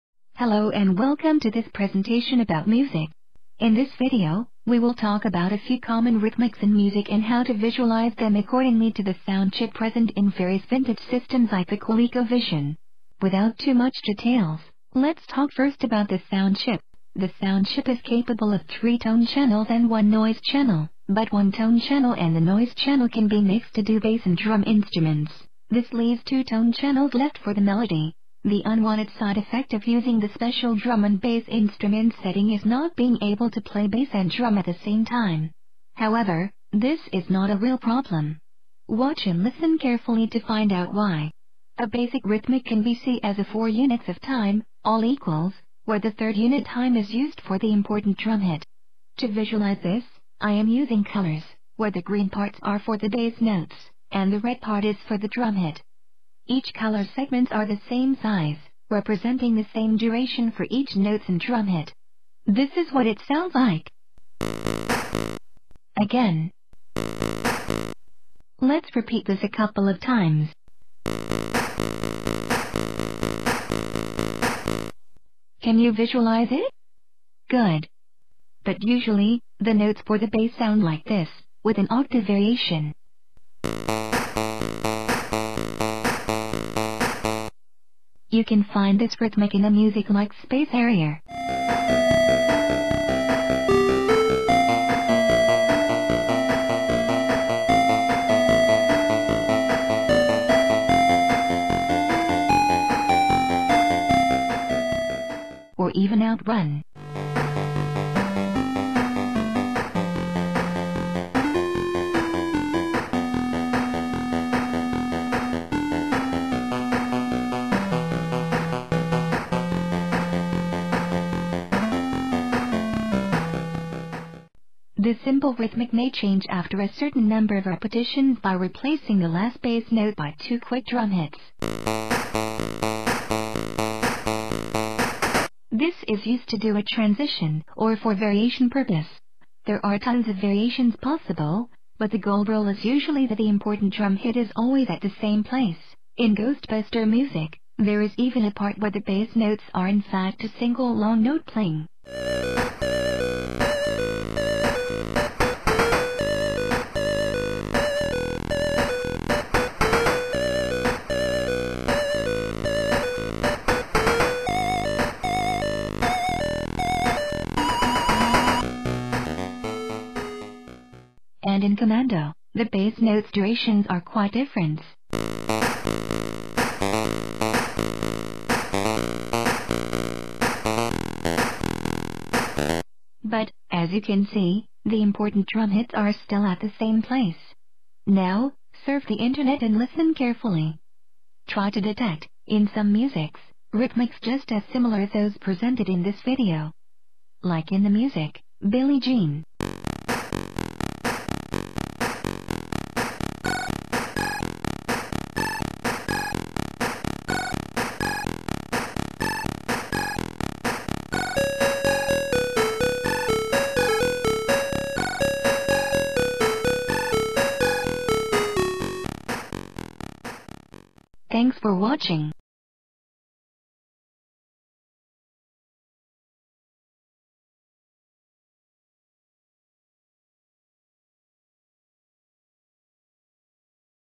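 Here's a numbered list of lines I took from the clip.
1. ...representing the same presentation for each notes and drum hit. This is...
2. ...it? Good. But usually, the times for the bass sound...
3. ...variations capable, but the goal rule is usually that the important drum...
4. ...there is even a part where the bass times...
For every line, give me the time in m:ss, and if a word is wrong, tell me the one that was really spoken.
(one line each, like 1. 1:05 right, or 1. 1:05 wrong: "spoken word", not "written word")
1. 0:58 wrong: "duration", not "presentation"
2. 1:16 wrong: "notes", not "times"
3. 2:20 wrong: "possible", not "capable"
4. 2:27 wrong: "notes", not "times".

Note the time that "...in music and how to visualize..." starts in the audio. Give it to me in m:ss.
0:06.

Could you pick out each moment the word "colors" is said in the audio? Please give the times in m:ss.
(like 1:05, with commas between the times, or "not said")
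0:51, 0:56.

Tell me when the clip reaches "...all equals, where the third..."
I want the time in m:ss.
0:44.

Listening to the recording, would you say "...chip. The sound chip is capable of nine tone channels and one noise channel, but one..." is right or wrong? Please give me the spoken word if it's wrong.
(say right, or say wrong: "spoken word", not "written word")
wrong: "three", not "nine".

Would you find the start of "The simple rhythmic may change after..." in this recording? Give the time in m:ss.
2:05.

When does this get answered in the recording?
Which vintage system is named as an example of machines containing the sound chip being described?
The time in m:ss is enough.
0:11.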